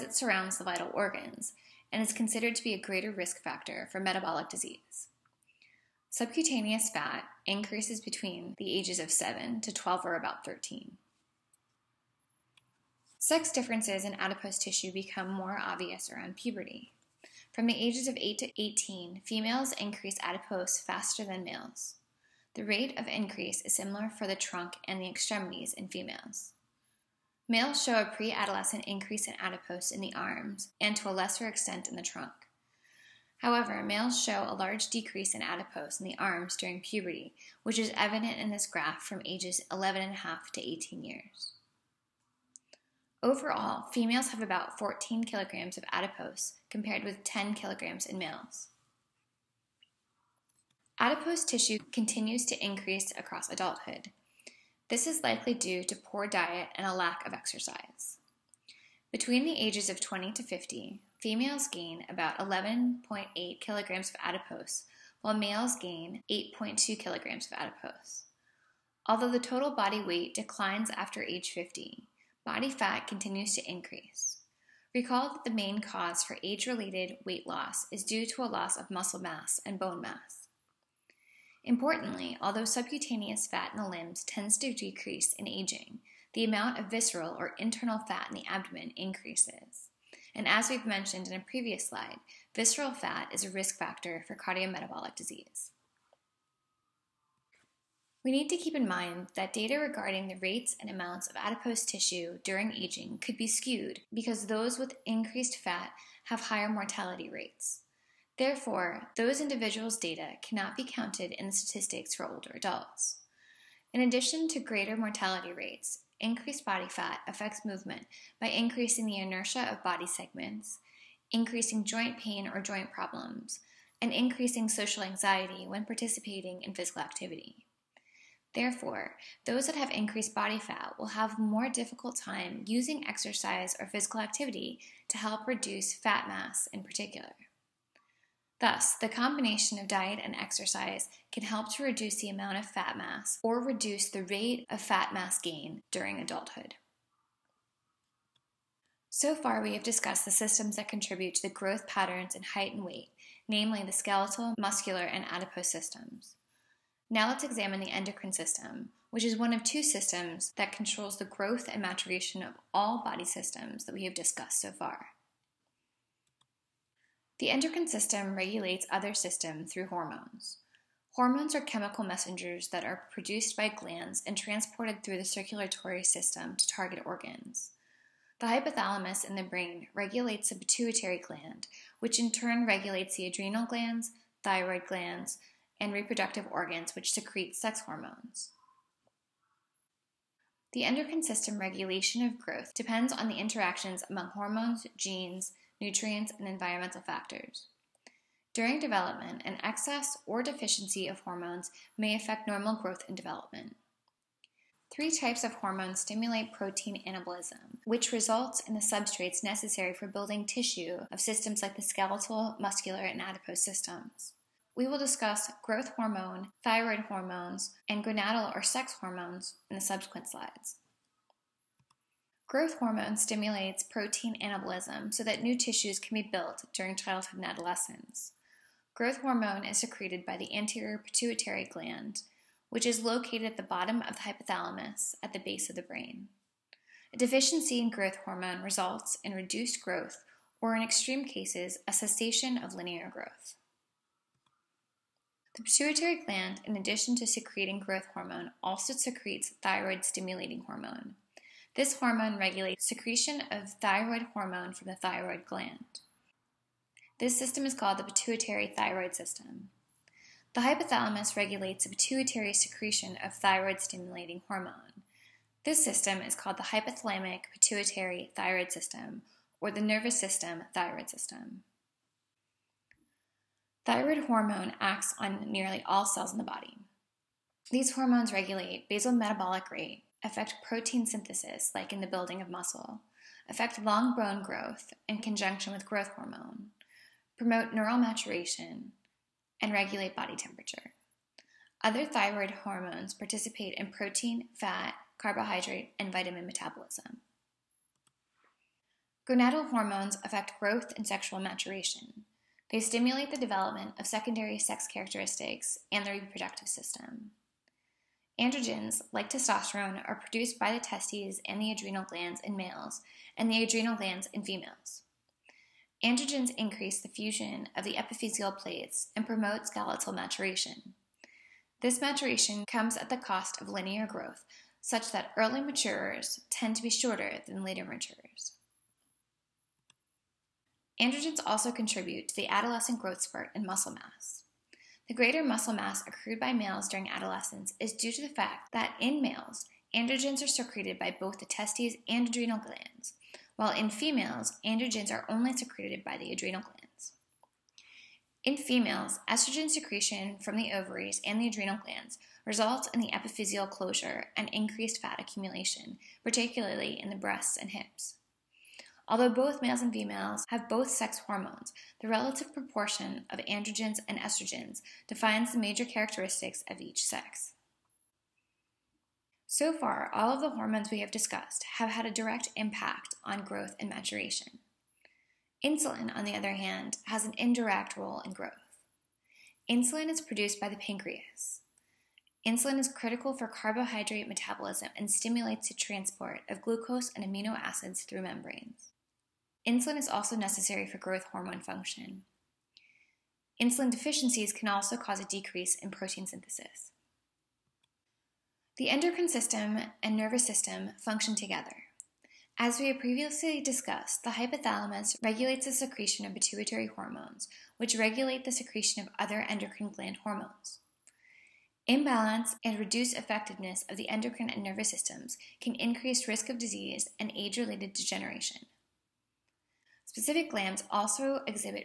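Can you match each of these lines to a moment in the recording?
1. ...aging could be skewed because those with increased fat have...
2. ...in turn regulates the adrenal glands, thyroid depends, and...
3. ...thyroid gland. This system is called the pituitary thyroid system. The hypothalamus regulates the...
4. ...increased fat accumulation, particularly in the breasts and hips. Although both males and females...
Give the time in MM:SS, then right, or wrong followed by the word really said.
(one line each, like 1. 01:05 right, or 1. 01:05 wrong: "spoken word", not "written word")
1. 01:42 right
2. 03:02 wrong: "glands", not "depends"
3. 04:14 right
4. 05:54 right.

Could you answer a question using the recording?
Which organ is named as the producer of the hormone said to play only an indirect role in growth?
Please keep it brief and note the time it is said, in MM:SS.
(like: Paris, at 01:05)
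pancreas, at 06:20.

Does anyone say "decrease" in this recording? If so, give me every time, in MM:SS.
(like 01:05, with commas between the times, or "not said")
00:34, 01:24, 06:35.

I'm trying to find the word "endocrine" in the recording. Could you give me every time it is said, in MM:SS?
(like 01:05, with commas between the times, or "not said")
02:37, 02:47, 03:10, 06:38, 06:49, 06:54.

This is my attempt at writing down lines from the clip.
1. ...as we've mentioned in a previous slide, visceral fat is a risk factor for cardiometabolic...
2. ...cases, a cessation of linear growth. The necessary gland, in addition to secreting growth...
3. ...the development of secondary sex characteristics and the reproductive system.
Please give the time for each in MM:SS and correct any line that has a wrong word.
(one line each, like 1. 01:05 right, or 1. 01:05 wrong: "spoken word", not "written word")
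1. 01:30 right
2. 04:01 wrong: "pituitary", not "necessary"
3. 05:03 right.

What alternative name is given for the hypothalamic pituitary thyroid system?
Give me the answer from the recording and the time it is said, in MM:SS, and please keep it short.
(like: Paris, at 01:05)
nervous system thyroid system, at 04:29.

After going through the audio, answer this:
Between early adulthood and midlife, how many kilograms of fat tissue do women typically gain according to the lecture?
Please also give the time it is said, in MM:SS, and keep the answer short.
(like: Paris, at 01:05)
11.8 kilograms, at 01:02.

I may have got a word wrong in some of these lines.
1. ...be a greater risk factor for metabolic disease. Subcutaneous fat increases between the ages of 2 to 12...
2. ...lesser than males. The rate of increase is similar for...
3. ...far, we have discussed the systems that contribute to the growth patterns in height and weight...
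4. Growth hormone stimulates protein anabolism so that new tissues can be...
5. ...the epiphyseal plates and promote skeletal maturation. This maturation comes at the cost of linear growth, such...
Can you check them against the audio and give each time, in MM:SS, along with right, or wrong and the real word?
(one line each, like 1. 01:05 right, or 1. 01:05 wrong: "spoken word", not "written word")
1. 00:02 wrong: "7", not "2"
2. 00:20 wrong: "faster", not "lesser"
3. 02:29 right
4. 03:42 right
5. 05:17 right.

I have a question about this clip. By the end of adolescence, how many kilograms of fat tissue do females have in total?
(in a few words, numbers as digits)
14 kilograms.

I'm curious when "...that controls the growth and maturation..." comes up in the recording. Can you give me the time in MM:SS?
02:40.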